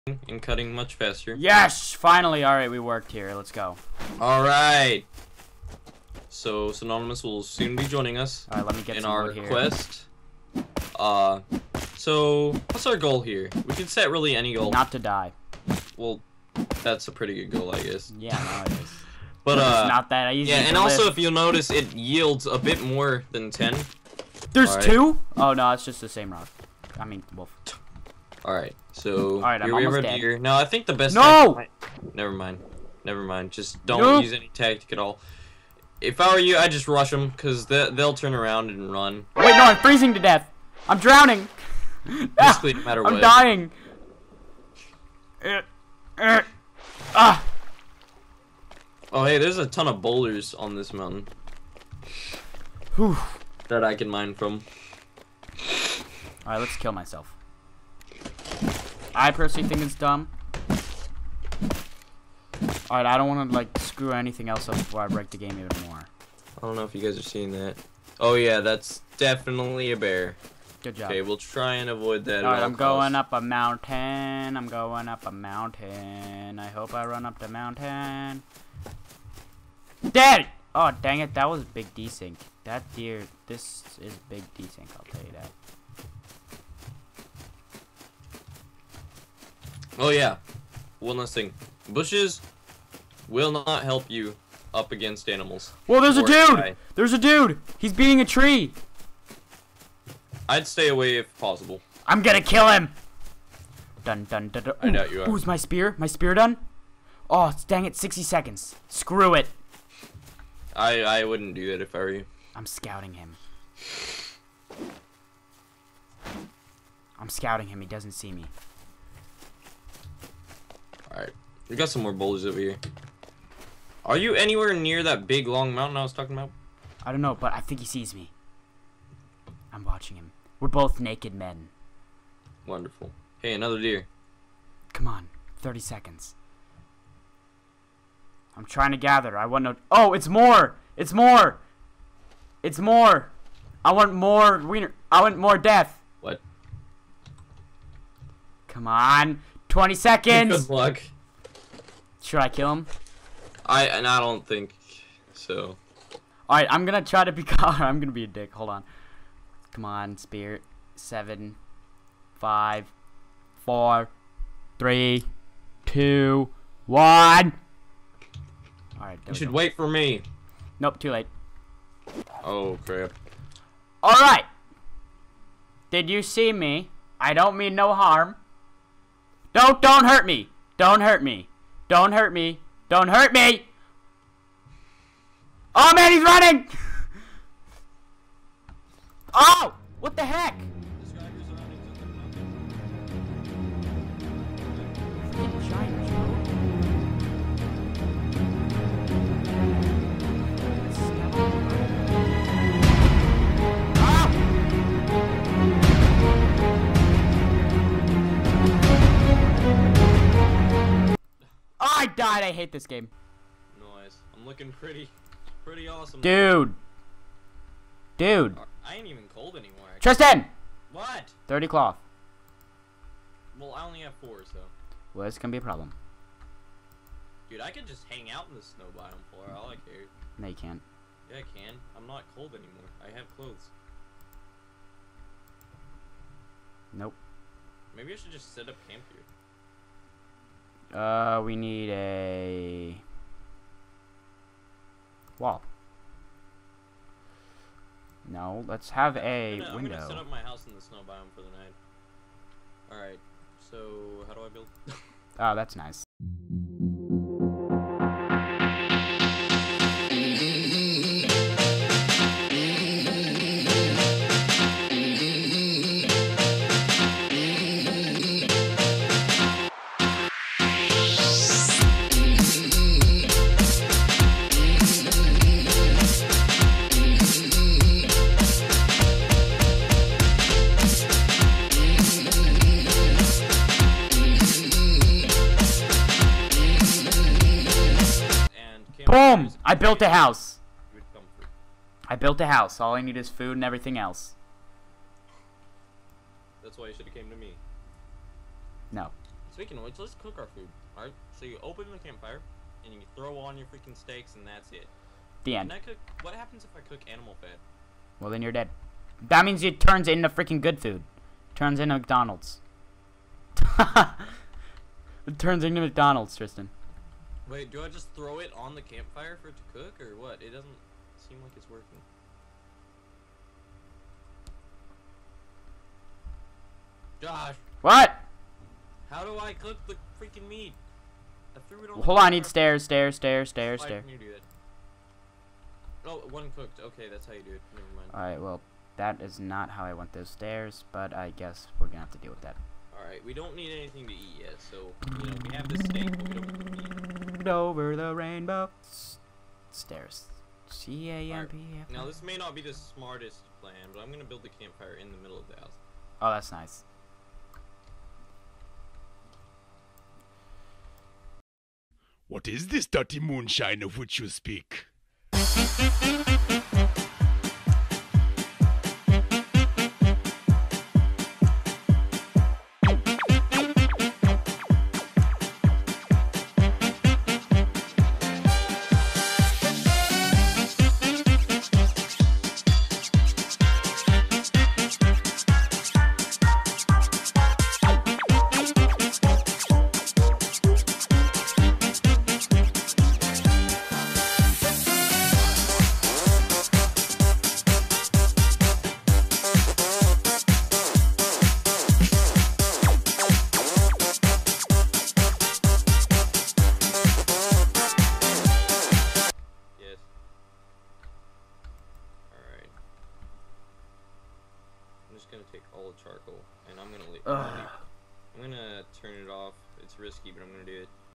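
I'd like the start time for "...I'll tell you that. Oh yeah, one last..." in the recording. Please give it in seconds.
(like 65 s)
84 s.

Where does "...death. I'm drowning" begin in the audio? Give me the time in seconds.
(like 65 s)
40 s.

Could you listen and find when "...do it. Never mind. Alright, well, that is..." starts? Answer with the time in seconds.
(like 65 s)
337 s.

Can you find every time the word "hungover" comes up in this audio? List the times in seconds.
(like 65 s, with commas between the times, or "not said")
not said.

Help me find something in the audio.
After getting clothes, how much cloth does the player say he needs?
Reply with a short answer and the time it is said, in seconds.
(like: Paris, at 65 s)
30, at 221 s.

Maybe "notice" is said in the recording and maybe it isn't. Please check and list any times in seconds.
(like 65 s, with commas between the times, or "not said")
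21 s.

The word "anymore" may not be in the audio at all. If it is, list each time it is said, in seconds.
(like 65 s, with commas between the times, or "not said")
219 s, 232 s.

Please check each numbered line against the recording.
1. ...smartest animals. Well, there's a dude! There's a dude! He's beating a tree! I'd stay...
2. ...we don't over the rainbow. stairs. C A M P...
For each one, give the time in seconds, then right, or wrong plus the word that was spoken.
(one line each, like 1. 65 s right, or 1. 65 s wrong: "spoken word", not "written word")
1. 94 s wrong: "against", not "smartest"
2. 346 s right.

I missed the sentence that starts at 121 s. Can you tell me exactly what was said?
We got some more boulders over here.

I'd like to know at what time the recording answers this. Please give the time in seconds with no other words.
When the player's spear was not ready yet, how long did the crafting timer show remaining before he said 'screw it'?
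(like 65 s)
107 s.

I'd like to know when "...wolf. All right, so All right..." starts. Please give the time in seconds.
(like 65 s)
27 s.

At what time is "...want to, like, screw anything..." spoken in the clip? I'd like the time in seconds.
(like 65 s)
63 s.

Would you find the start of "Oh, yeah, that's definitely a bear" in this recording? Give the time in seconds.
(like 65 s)
68 s.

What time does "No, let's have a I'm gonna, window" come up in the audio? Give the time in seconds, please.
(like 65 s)
248 s.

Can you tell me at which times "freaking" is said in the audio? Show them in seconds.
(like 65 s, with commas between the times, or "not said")
303 s, 310 s, 330 s.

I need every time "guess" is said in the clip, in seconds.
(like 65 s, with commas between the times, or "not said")
17 s, 341 s.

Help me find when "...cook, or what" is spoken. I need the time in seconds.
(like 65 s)
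319 s.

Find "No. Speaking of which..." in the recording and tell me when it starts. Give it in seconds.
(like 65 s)
298 s.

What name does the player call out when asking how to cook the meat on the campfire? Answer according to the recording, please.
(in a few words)
Josh.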